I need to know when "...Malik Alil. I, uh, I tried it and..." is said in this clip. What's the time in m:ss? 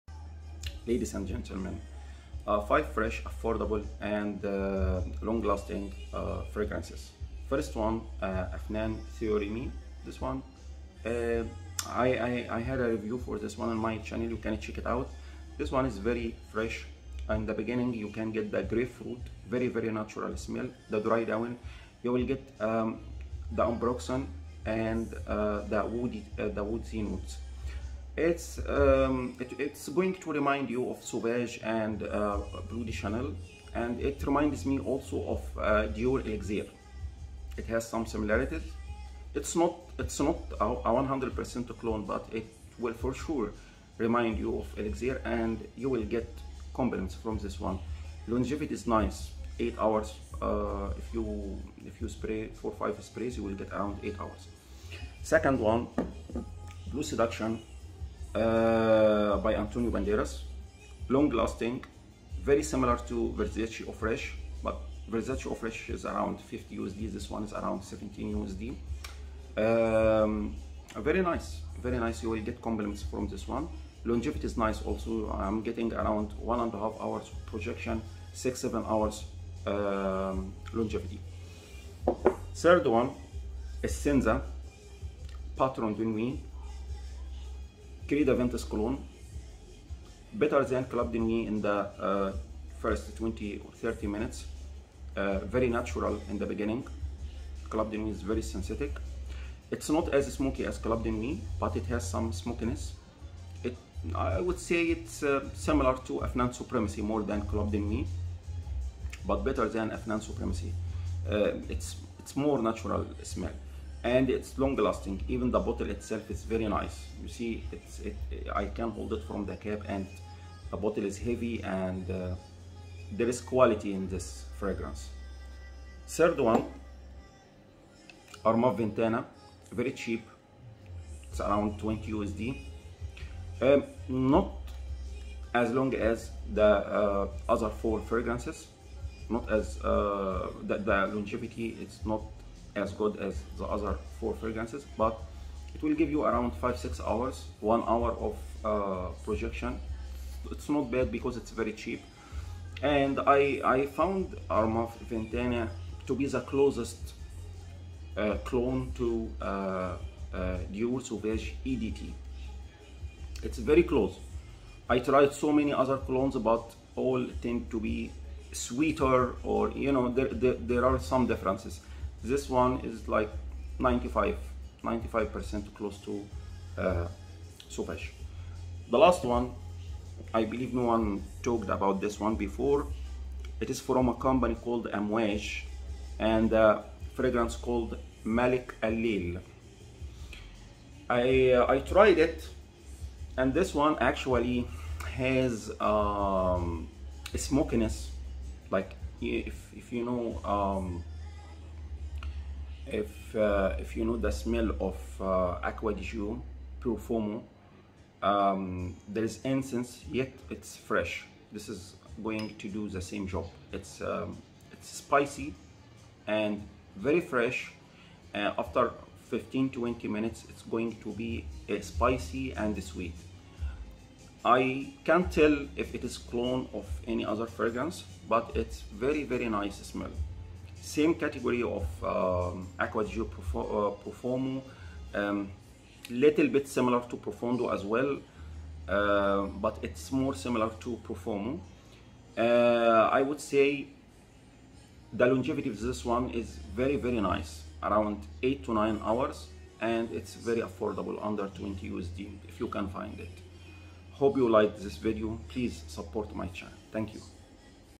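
3:08.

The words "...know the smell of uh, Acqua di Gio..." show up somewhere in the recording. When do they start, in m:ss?
3:24.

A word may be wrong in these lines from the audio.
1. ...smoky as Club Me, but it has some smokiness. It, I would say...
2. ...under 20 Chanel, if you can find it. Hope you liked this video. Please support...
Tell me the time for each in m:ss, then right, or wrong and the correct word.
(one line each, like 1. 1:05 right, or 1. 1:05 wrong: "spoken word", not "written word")
1. 1:40 right
2. 4:11 wrong: "USD", not "Chanel".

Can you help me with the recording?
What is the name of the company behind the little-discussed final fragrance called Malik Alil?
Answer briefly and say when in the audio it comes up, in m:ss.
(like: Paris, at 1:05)
Amwesh, at 3:04.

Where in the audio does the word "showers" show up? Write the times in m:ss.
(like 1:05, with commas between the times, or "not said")
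not said.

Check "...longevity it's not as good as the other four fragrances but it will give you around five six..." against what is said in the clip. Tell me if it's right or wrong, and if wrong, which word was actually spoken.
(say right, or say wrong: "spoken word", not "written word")
right.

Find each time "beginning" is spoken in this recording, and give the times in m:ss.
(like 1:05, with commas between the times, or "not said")
0:17, 1:36.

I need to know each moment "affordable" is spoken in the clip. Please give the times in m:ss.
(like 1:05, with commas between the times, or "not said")
0:03, 4:10.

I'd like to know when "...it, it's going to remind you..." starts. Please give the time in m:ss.
0:29.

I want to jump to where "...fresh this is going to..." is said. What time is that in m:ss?
3:30.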